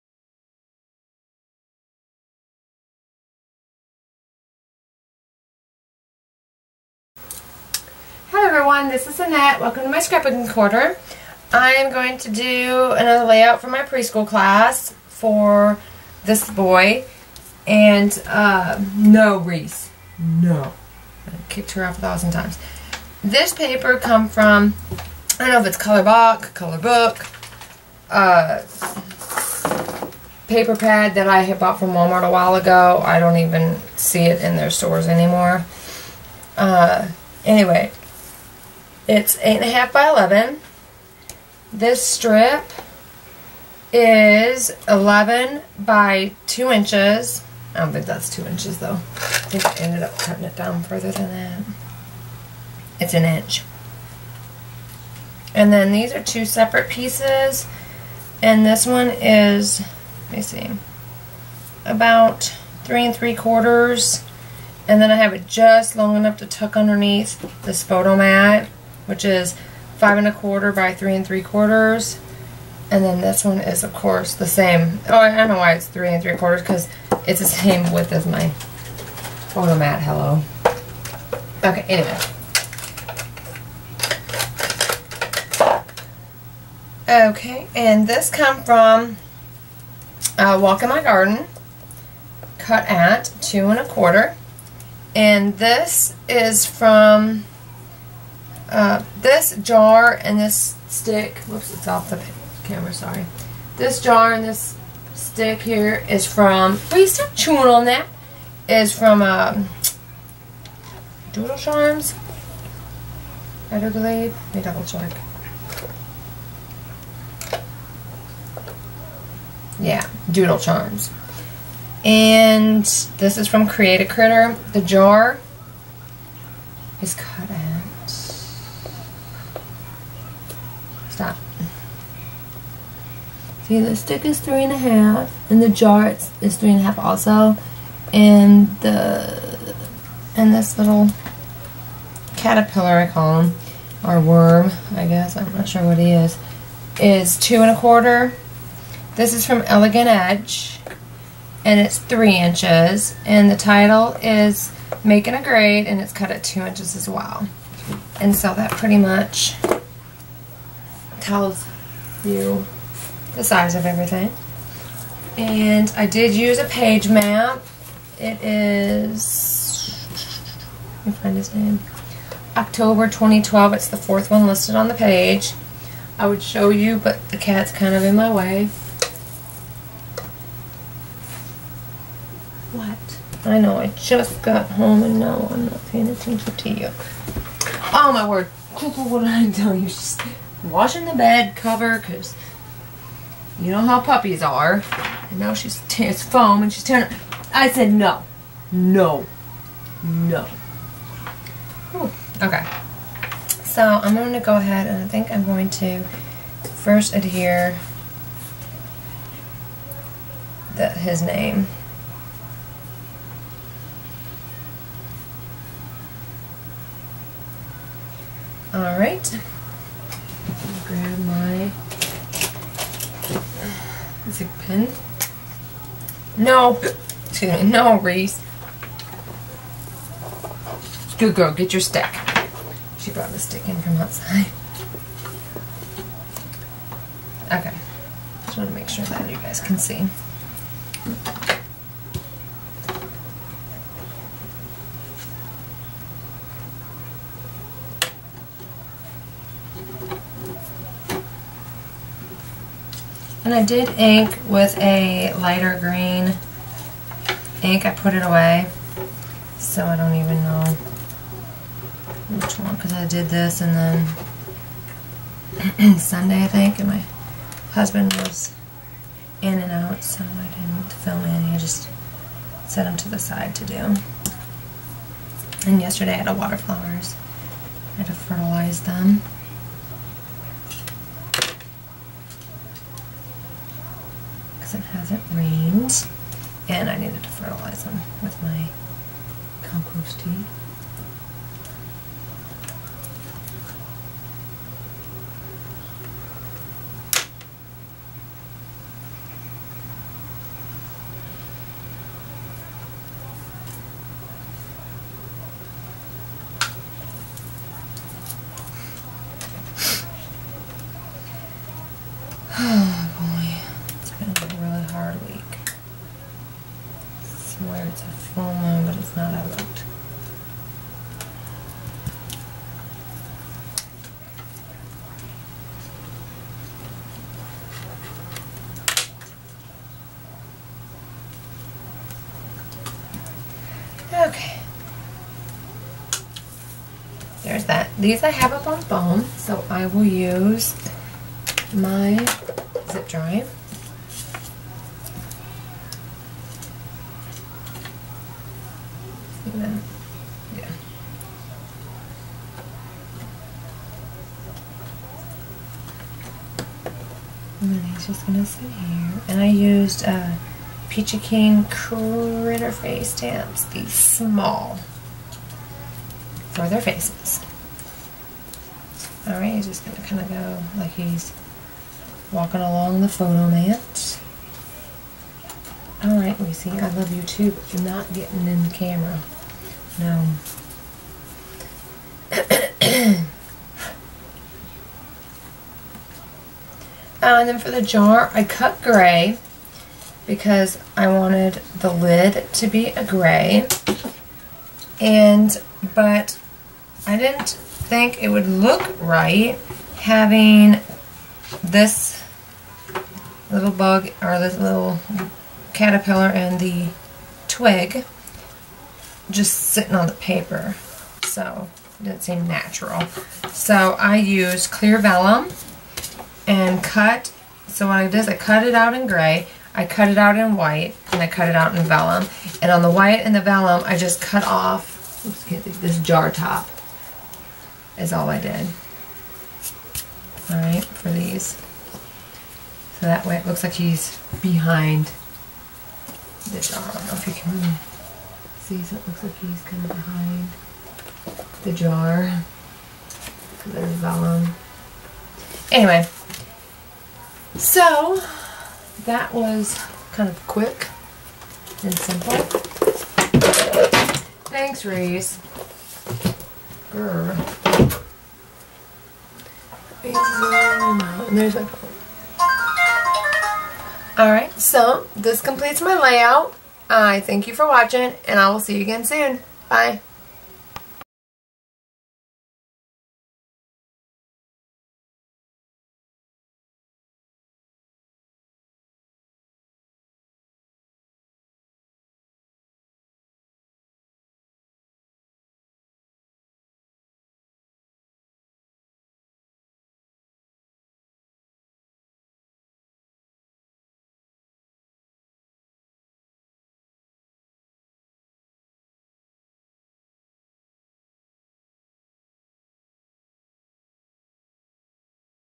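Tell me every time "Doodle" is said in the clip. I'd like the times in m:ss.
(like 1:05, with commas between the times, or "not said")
1:51, 2:00.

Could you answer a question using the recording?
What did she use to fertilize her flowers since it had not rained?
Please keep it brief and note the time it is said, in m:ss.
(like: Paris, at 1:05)
compost tea, at 4:49.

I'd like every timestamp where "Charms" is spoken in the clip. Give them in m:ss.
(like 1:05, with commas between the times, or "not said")
1:51, 2:00.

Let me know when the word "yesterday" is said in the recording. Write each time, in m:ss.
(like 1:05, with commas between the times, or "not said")
4:35.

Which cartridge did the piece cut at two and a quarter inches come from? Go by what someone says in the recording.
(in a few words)
Walk in My Garden.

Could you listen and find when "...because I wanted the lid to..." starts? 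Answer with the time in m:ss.
6:30.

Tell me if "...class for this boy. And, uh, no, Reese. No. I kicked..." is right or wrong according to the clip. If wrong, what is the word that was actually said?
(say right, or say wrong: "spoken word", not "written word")
right.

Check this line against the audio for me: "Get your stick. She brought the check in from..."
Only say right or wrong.
wrong.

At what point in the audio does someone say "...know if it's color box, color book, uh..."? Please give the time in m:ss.
0:25.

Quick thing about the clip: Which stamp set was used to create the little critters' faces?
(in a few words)
Peachy Keen Critter Face.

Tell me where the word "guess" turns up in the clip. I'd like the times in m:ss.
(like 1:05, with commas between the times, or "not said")
2:25.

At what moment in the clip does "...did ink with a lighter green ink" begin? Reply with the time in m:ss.
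4:13.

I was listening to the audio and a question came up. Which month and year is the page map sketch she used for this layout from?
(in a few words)
October 2012.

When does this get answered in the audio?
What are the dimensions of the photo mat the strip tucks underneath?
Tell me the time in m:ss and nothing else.
1:09.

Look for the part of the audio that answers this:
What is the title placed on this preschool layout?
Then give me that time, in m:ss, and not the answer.
2:35.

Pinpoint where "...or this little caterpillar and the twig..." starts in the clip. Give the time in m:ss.
6:44.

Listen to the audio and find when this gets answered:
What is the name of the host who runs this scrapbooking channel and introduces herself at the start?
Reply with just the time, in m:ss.
0:09.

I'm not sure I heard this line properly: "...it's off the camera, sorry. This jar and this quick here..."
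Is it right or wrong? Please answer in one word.
wrong.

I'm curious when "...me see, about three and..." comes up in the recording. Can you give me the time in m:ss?
1:00.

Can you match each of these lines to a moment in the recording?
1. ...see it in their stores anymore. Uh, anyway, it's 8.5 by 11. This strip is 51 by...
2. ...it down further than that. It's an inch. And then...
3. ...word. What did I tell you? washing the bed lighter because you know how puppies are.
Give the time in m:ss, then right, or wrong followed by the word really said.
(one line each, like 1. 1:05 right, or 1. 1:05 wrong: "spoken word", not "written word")
1. 0:33 wrong: "11", not "51"
2. 0:50 right
3. 3:08 wrong: "cover", not "lighter".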